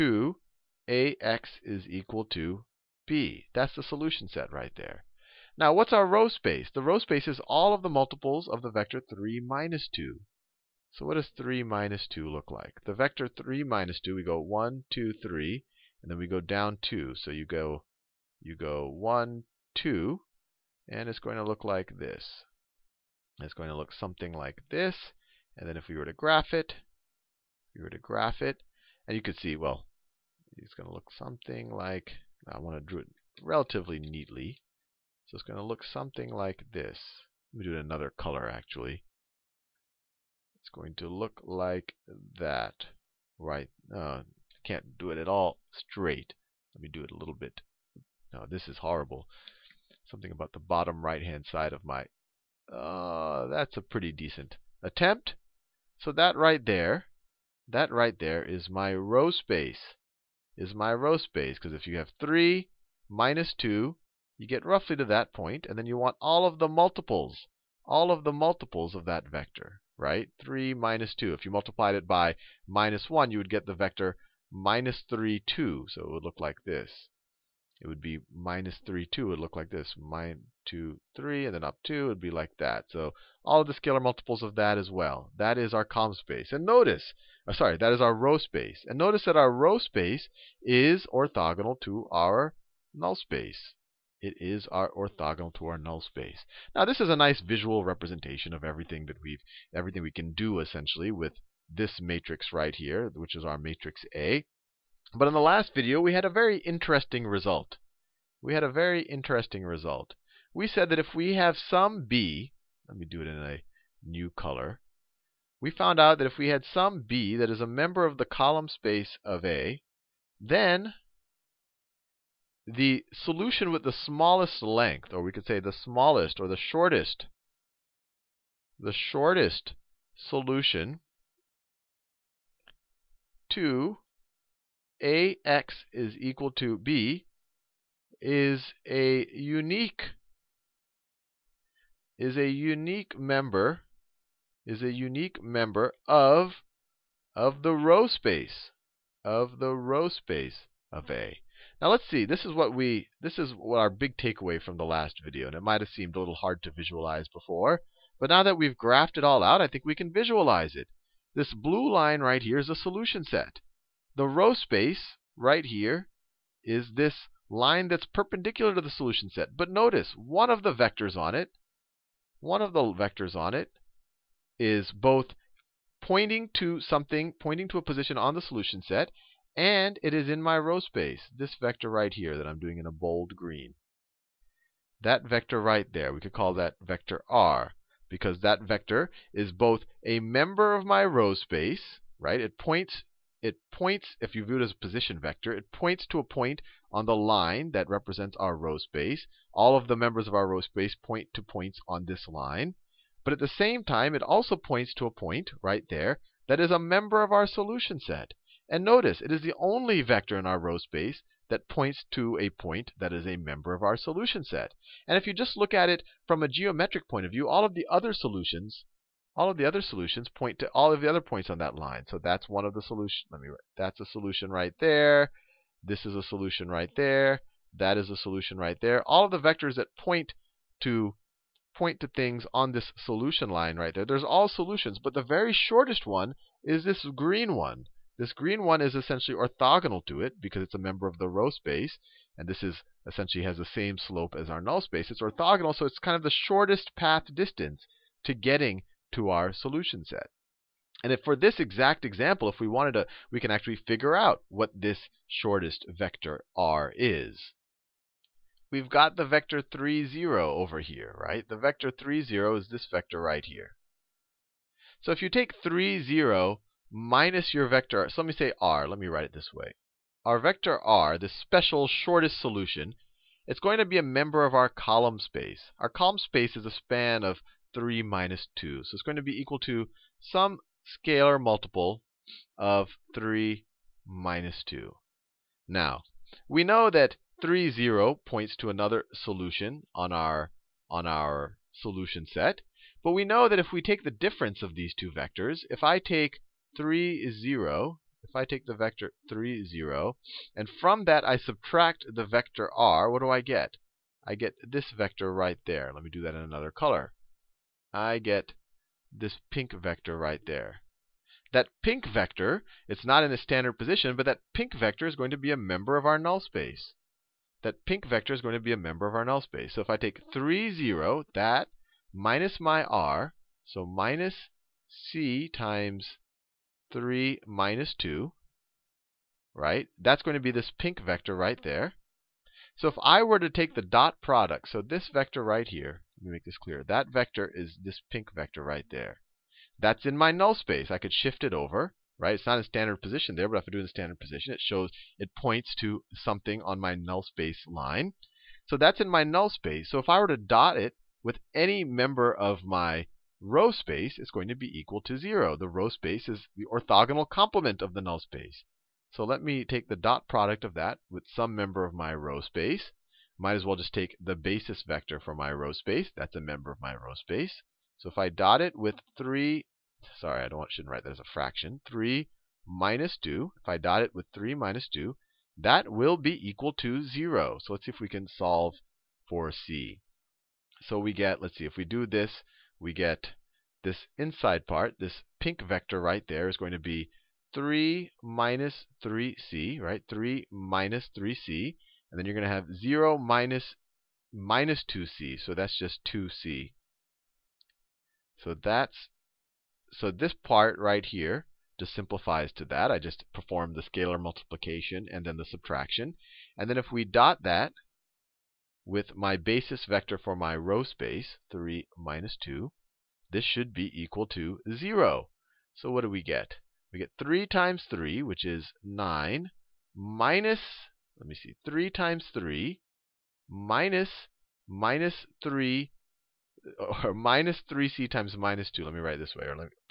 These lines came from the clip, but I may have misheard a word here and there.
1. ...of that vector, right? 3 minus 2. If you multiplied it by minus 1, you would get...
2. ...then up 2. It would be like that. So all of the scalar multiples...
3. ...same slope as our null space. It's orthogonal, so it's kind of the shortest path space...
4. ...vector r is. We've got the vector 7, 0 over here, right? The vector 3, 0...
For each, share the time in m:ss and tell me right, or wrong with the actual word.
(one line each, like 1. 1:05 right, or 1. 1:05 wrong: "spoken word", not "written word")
1. 1:08 right
2. 1:21 right
3. 4:03 wrong: "distance", not "space"
4. 4:15 wrong: "3", not "7".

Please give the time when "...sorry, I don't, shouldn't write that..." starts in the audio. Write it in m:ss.
6:10.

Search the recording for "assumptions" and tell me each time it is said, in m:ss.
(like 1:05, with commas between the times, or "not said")
not said.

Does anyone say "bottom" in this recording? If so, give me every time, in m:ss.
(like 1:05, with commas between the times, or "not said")
0:50.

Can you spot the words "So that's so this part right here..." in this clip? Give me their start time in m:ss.
6:38.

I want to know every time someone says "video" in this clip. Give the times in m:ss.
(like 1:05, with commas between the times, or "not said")
1:45, 2:35.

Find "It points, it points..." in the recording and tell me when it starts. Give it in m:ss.
3:12.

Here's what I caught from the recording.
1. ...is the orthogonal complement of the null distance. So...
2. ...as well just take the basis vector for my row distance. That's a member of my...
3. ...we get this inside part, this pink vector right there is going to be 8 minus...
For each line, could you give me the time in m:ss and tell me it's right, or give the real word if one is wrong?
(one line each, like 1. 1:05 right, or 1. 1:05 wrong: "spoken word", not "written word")
1. 5:56 wrong: "space", not "distance"
2. 6:03 wrong: "space", not "distance"
3. 6:22 wrong: "3", not "8".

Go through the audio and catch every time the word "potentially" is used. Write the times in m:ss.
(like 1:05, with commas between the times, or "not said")
not said.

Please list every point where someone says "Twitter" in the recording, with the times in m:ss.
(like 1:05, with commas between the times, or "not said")
not said.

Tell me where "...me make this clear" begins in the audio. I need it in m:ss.
5:36.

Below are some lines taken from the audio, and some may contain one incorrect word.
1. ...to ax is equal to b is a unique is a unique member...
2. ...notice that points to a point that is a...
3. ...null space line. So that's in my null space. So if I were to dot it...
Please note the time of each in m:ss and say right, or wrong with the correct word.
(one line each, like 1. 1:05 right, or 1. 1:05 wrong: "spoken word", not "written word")
1. 2:13 right
2. 3:30 wrong: "space", not "notice"
3. 5:46 right.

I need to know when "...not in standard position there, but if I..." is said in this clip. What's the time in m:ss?
5:42.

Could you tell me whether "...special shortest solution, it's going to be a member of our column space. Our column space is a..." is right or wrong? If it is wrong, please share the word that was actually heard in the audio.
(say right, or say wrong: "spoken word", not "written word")
right.